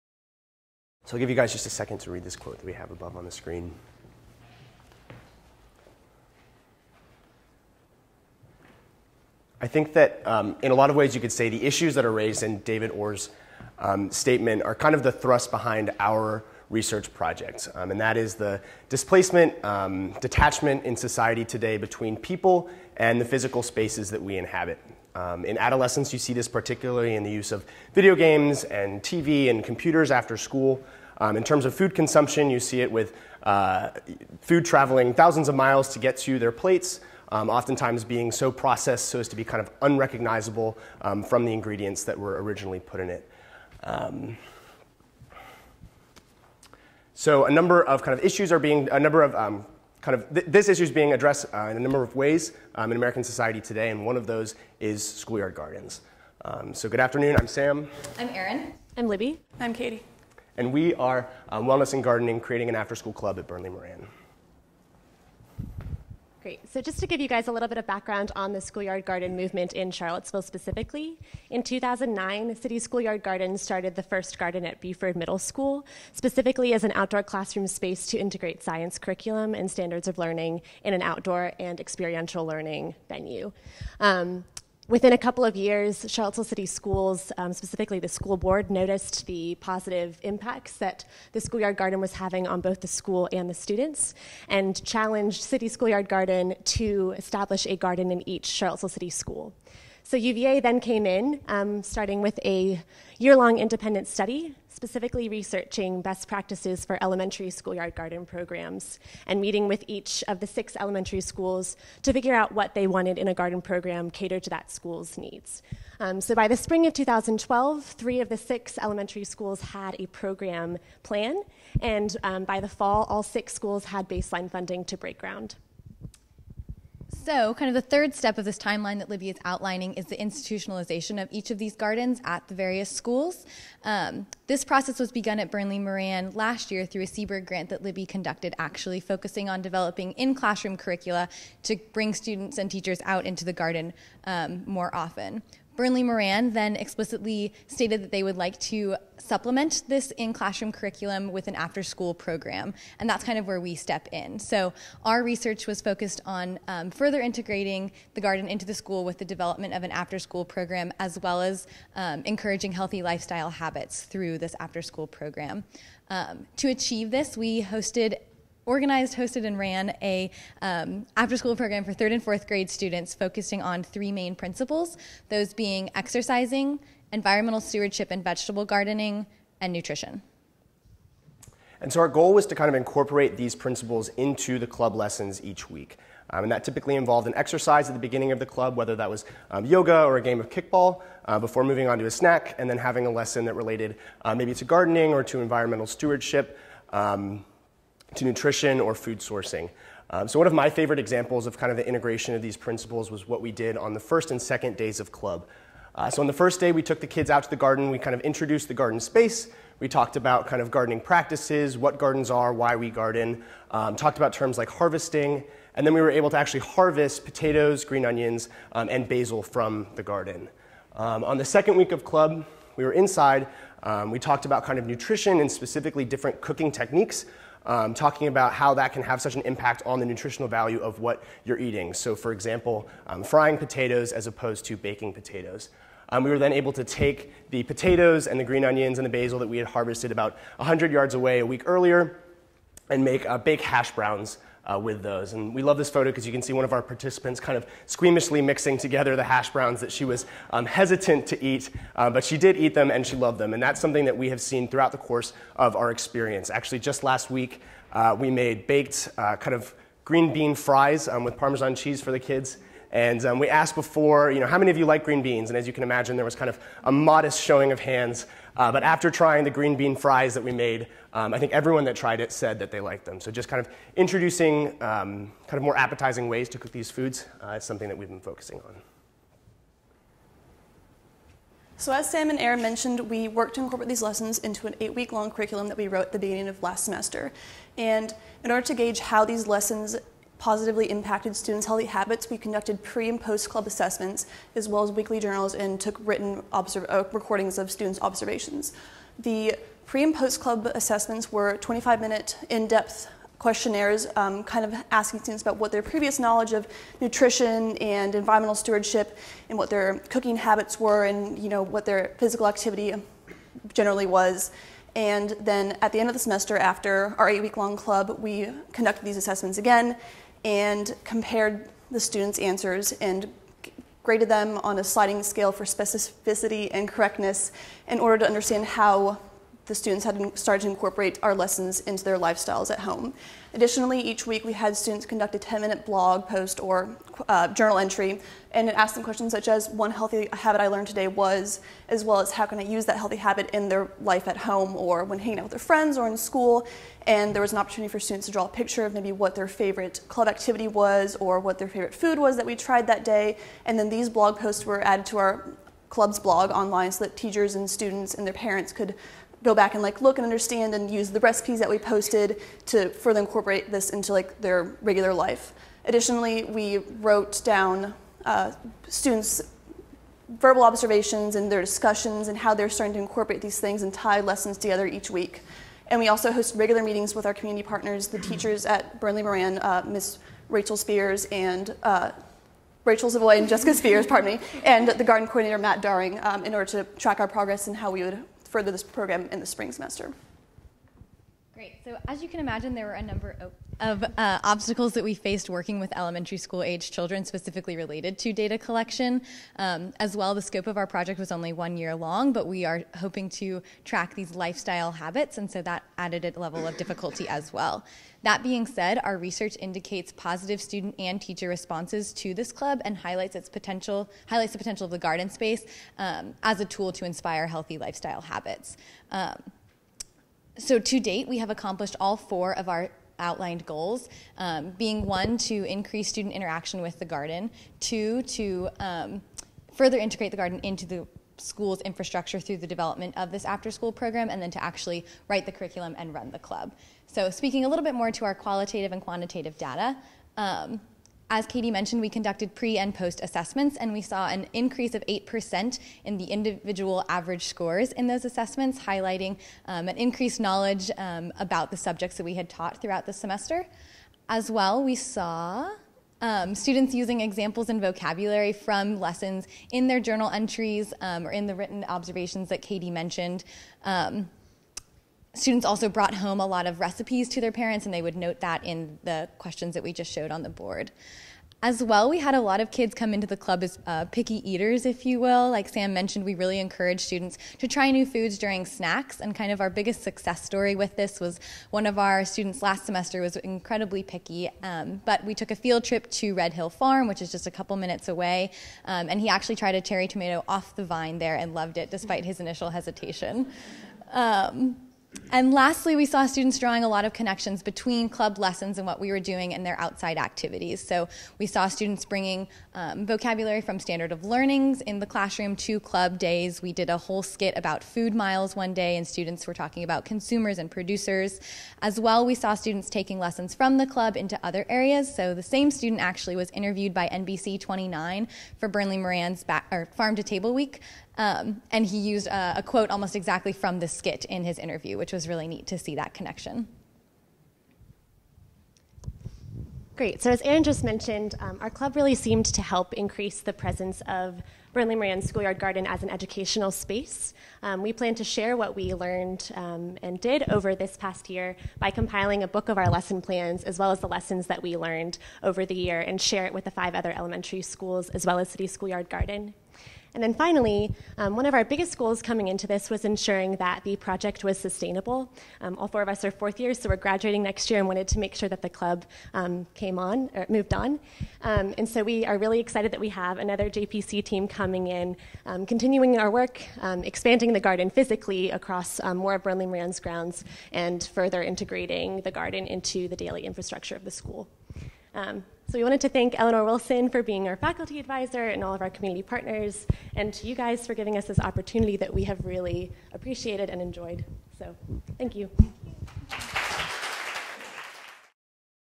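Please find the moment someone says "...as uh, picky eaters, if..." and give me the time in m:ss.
7:53.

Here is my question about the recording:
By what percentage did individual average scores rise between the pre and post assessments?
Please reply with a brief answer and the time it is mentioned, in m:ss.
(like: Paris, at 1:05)
8%, at 7:25.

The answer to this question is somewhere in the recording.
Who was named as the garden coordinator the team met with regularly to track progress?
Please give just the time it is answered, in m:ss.
6:25.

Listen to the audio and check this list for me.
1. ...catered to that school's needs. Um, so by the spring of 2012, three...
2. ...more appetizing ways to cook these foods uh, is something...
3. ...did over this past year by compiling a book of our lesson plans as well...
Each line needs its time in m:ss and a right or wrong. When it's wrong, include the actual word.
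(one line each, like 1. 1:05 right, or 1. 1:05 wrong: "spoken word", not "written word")
1. 1:54 right
2. 4:35 right
3. 9:00 right.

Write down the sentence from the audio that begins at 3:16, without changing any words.
Um, to nutrition or food sourcing.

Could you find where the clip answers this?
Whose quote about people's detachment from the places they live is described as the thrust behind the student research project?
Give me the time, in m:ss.
0:12.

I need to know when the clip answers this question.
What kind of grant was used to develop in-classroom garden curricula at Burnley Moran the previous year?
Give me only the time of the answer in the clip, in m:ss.
2:17.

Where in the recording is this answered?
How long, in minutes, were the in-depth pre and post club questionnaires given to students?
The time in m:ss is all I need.
5:01.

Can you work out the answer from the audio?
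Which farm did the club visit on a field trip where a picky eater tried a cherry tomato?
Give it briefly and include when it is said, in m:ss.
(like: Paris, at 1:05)
Red Hill Farm, at 8:06.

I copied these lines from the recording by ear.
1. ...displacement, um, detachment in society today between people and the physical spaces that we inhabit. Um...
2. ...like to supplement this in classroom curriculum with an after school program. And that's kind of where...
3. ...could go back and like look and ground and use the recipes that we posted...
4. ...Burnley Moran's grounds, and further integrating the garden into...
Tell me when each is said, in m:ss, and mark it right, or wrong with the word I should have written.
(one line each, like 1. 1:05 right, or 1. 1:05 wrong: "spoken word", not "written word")
1. 0:18 right
2. 2:28 right
3. 5:58 wrong: "understand", not "ground"
4. 9:29 right.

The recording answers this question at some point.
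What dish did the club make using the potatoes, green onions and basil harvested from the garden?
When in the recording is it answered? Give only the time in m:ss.
4:18.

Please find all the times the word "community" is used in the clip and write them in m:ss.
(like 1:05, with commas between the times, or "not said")
6:17, 9:38.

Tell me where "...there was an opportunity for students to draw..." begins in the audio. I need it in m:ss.
5:47.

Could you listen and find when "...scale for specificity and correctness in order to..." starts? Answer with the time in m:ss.
5:25.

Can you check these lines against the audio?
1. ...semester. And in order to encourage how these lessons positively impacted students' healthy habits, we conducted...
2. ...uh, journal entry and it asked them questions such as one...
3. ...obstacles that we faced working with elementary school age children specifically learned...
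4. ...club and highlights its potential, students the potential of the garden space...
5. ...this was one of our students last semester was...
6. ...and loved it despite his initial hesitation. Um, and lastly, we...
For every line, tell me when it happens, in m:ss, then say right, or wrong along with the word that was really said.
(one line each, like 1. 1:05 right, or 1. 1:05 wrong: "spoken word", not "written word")
1. 4:46 wrong: "gauge", not "encourage"
2. 5:37 right
3. 6:34 wrong: "related", not "learned"
4. 6:52 wrong: "highlights", not "students"
5. 8:00 right
6. 8:11 right.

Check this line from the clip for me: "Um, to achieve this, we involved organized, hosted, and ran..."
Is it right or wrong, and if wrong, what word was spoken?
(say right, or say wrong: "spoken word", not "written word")
wrong: "hosted", not "involved".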